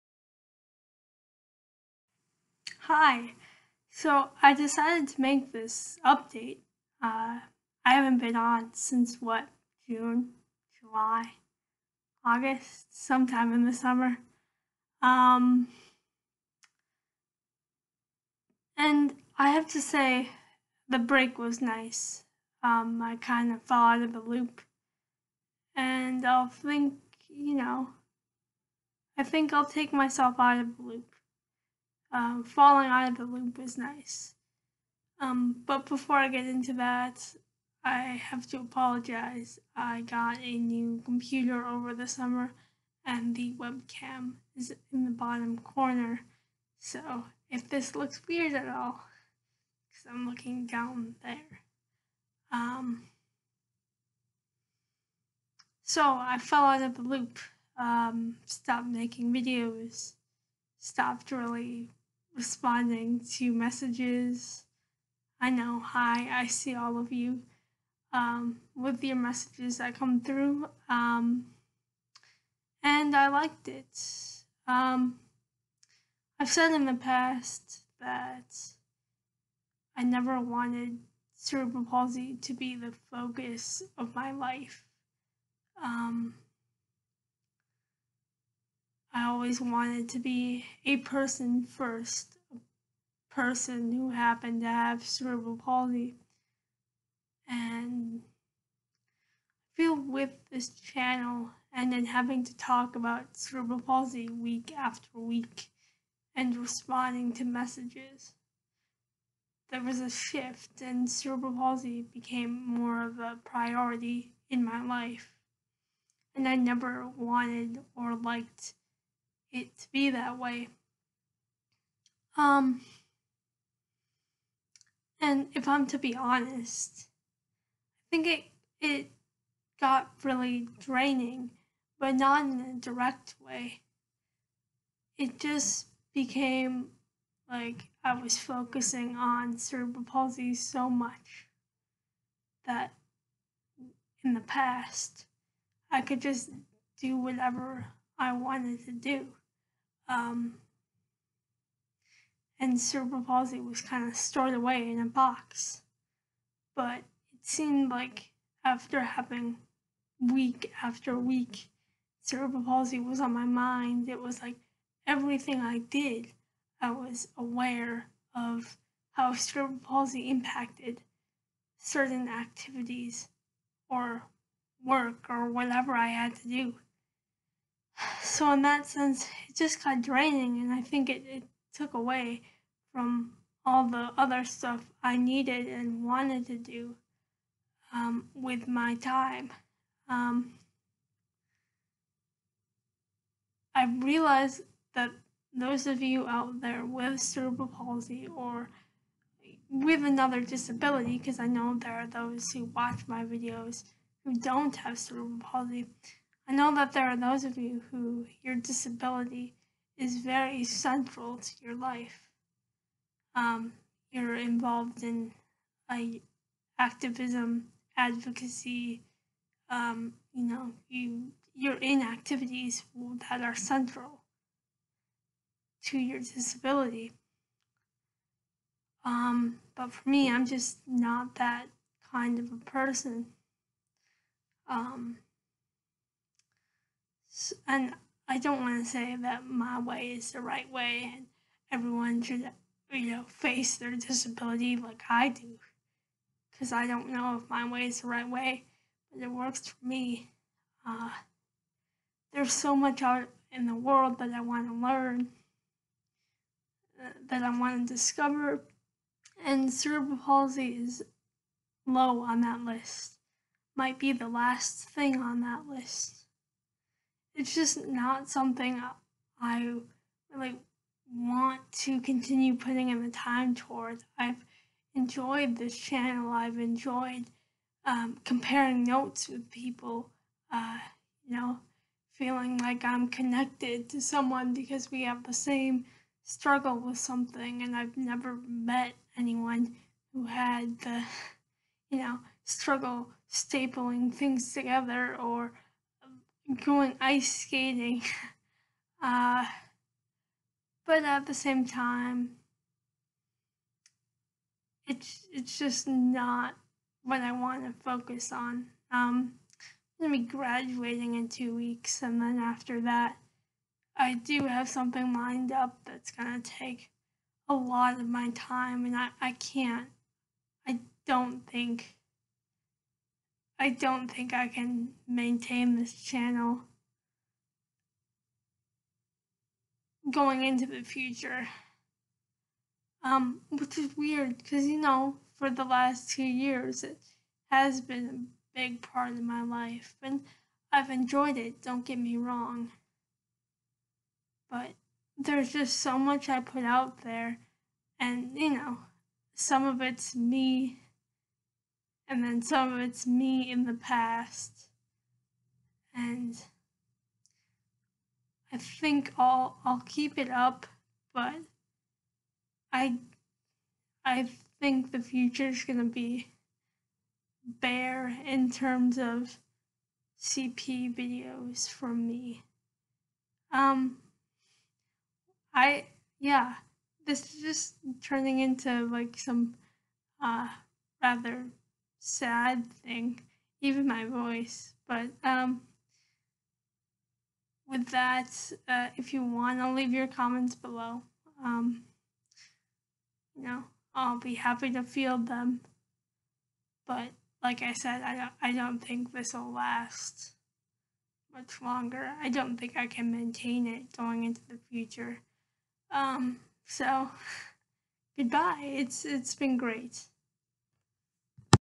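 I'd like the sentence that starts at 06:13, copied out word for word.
Um I yeah, this is just turning into like some uh rather sad thing, even my voice.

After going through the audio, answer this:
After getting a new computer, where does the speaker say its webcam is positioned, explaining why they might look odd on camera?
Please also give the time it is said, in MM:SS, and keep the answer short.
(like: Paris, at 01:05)
bottom corner, at 00:45.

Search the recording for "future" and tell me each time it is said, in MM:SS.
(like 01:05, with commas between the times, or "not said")
05:30, 06:04, 06:44.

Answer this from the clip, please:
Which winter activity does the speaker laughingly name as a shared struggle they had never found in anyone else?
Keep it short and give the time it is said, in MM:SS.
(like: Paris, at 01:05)
ice skating, at 04:57.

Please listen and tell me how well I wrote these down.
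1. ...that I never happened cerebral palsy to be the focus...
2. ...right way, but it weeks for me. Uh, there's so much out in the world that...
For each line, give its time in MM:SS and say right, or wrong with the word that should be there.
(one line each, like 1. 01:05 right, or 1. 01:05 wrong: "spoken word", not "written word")
1. 01:17 wrong: "wanted", not "happened"
2. 04:08 wrong: "works", not "weeks".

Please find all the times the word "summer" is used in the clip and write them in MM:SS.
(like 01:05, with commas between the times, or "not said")
00:13, 00:42.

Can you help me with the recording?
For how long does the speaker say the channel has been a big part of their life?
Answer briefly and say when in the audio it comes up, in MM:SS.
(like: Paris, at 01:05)
2 years, at 05:36.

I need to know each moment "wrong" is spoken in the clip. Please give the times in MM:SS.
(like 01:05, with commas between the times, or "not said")
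05:42.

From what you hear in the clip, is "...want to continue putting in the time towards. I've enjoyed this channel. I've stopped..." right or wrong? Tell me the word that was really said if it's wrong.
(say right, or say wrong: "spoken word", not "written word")
wrong: "enjoyed", not "stopped".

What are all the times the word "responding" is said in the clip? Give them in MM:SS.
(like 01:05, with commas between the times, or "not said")
01:02, 01:46.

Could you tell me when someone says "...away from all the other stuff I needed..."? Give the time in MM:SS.
03:01.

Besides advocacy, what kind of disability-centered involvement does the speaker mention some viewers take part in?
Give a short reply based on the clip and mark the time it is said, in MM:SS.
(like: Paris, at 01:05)
activism, at 03:36.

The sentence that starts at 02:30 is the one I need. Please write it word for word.
Um, and cerebral palsy was kind of stored away in a box.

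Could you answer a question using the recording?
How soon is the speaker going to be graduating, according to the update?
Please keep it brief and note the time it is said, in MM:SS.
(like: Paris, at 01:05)
2 weeks, at 05:11.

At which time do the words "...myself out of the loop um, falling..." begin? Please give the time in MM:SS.
00:29.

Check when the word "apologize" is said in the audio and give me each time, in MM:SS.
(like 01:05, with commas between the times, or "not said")
00:38.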